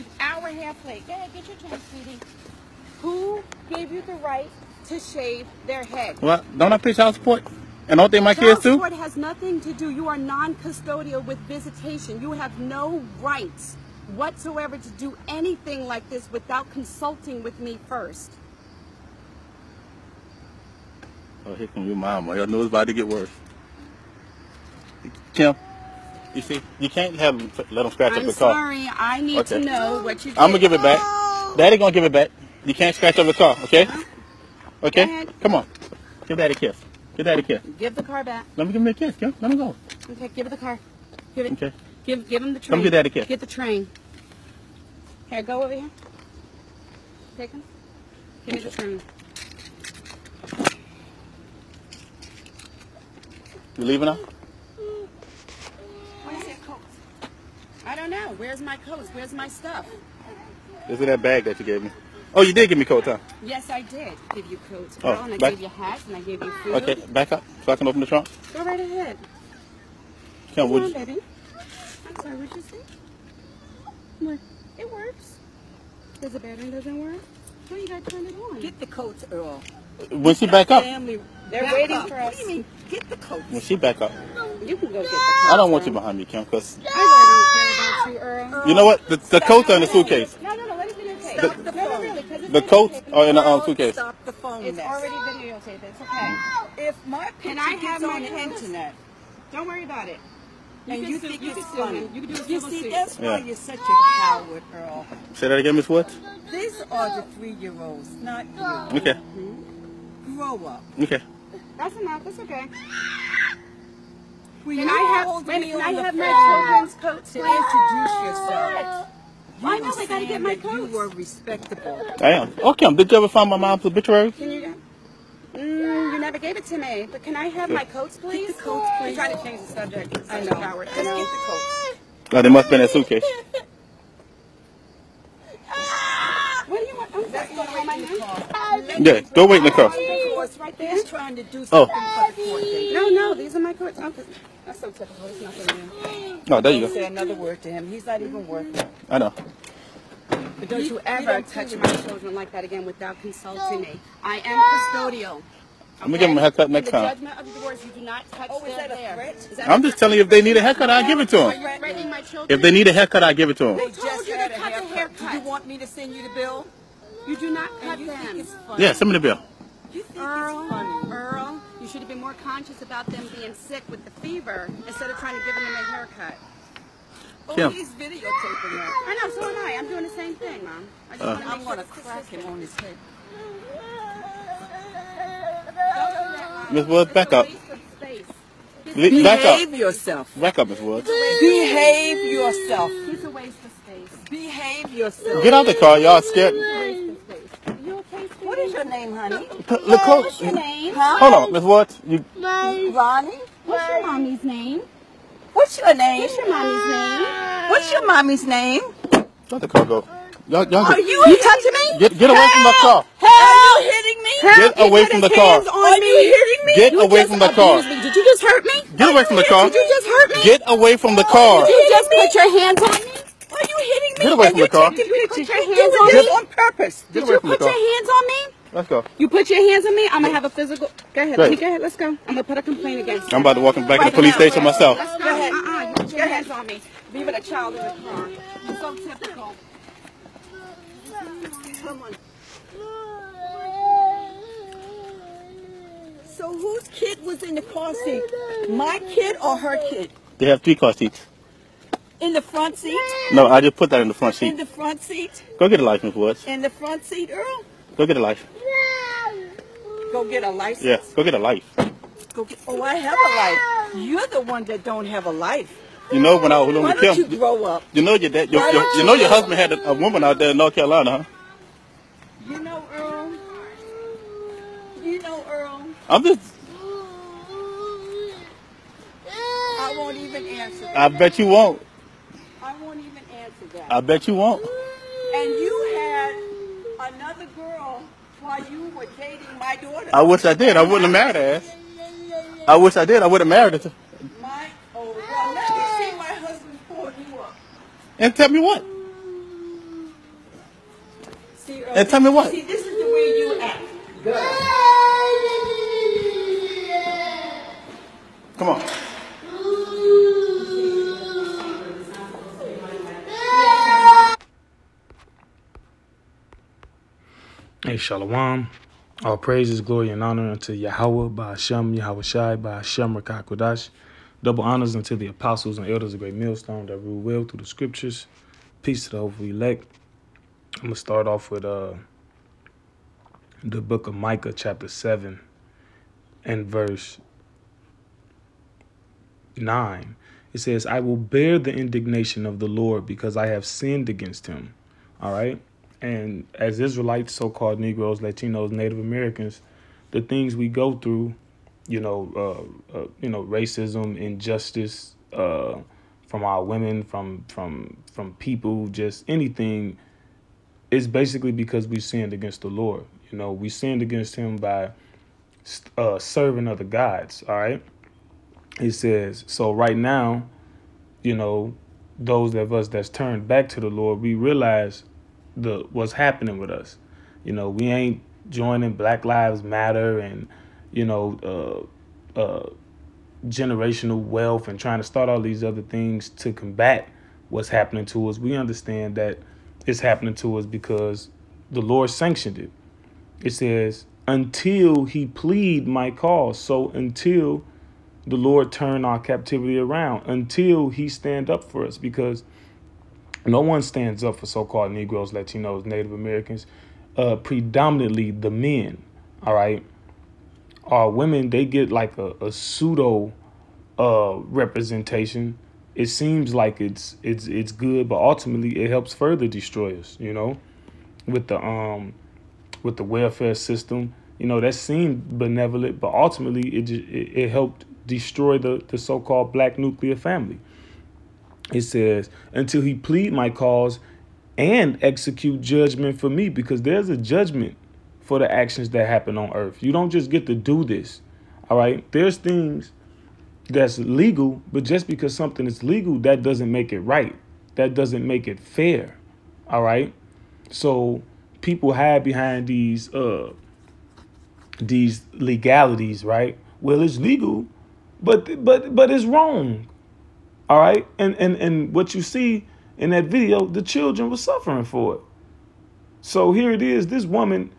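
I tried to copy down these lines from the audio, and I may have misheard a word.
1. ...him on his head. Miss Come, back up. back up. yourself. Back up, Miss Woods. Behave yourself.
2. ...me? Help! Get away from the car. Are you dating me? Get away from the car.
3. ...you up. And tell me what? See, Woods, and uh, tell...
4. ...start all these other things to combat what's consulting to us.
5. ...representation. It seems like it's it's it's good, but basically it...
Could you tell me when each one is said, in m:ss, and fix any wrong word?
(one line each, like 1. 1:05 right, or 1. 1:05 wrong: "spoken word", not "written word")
1. 3:02 wrong: "Woods", not "Come"
2. 3:34 wrong: "hitting", not "dating"
3. 4:57 wrong: "Earl", not "Woods"
4. 6:25 wrong: "happening", not "consulting"
5. 6:54 wrong: "ultimately", not "basically".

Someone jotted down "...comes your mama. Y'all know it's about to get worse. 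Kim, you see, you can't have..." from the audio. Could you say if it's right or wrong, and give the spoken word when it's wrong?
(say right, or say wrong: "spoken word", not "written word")
right.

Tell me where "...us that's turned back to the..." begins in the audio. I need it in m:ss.
6:12.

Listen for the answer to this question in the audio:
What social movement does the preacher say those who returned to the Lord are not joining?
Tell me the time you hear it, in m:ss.
6:18.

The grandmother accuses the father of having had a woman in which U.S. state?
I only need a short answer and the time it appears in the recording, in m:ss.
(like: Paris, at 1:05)
North Carolina, at 4:30.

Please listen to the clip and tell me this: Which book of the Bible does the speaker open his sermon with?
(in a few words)
Micah.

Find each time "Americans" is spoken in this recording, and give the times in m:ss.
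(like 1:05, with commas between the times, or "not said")
5:48, 6:46.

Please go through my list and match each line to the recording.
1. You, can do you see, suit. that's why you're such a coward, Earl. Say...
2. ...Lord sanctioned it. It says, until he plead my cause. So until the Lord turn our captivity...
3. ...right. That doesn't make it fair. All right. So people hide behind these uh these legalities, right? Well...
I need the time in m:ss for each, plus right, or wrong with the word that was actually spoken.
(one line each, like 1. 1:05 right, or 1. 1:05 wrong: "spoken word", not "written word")
1. 1:42 right
2. 6:31 right
3. 7:26 right.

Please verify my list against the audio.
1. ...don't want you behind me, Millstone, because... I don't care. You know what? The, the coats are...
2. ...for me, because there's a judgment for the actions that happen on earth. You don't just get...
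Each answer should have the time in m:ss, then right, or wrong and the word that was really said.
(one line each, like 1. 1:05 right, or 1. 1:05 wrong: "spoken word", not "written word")
1. 1:25 wrong: "Kim", not "Millstone"
2. 7:16 right.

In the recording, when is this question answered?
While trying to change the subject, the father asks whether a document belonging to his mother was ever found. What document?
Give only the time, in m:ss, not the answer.
2:03.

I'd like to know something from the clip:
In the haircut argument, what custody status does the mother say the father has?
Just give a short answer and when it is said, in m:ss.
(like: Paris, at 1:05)
Non-custodial with visitation, at 0:10.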